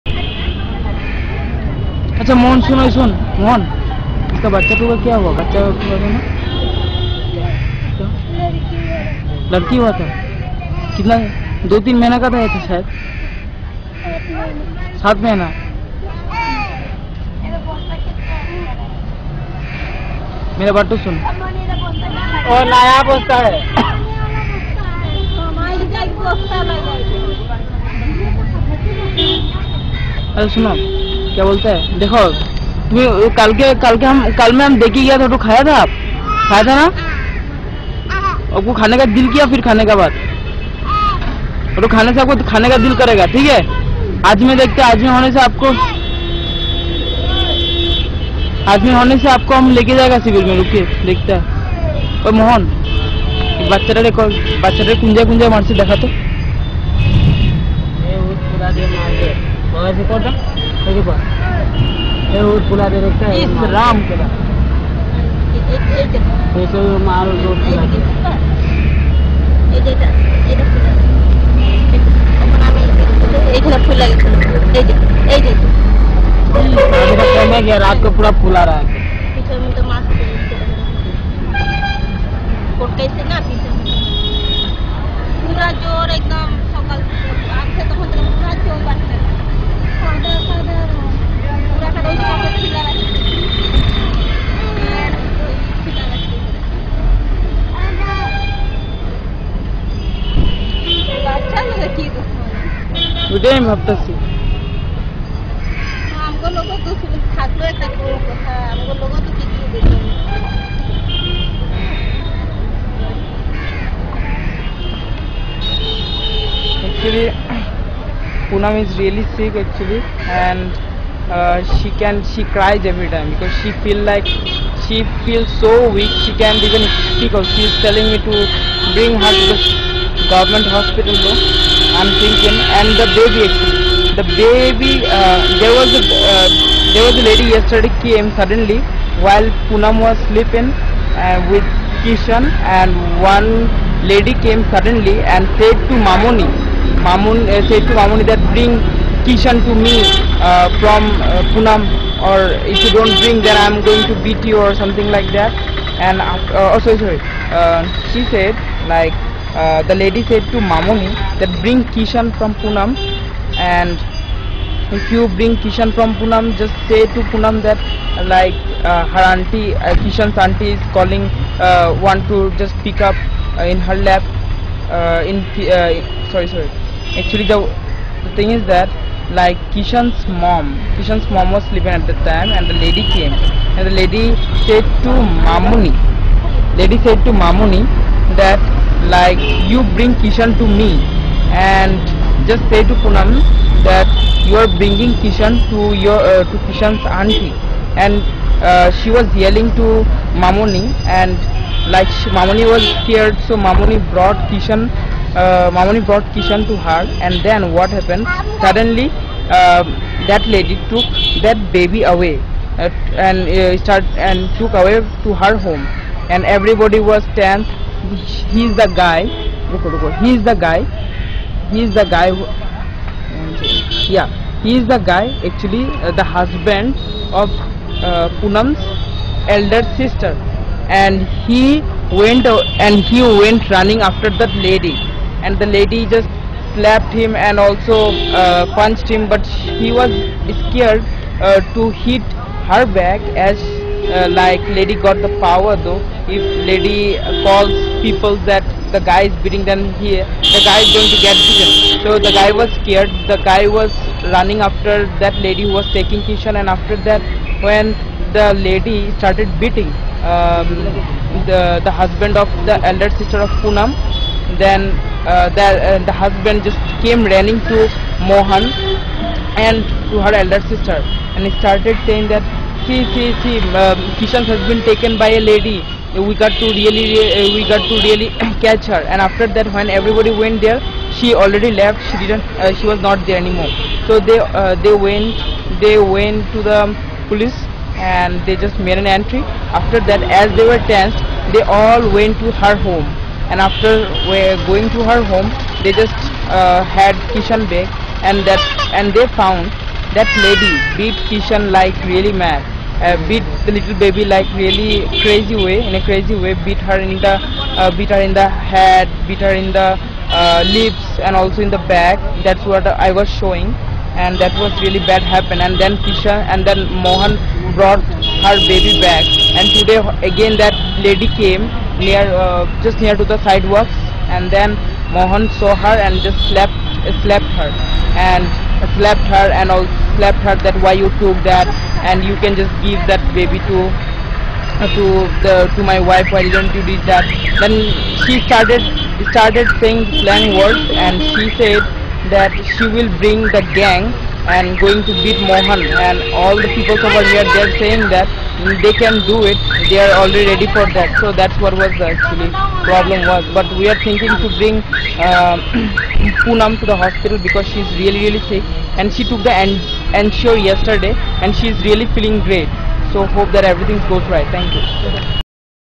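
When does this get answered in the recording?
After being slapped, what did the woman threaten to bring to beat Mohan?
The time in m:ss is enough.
5:43.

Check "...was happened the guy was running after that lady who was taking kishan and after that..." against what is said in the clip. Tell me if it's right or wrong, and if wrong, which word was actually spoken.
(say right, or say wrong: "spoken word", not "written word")
wrong: "scared", not "happened".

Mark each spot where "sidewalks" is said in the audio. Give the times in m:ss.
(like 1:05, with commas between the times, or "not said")
5:23.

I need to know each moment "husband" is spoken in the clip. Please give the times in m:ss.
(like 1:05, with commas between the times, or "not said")
3:46, 4:21, 4:26.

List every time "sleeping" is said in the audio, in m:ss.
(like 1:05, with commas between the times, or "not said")
2:20, 3:01.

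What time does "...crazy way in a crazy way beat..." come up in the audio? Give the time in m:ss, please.
5:05.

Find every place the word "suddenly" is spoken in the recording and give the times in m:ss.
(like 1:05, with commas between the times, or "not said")
2:18, 2:24, 3:28.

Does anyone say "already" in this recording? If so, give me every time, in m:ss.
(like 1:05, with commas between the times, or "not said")
4:41, 5:50.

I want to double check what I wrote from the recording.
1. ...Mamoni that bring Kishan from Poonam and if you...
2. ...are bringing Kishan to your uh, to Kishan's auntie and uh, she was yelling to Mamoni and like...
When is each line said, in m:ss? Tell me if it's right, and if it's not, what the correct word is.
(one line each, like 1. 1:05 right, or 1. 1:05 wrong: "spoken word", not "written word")
1. 2:40 right
2. 3:14 right.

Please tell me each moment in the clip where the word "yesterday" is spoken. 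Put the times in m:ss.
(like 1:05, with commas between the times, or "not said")
2:17, 6:00.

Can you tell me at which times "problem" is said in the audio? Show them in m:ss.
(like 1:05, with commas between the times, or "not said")
5:52.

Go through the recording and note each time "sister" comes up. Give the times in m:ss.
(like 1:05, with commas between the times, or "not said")
3:49, 4:23, 4:30.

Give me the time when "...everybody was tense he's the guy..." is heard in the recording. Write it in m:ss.
3:36.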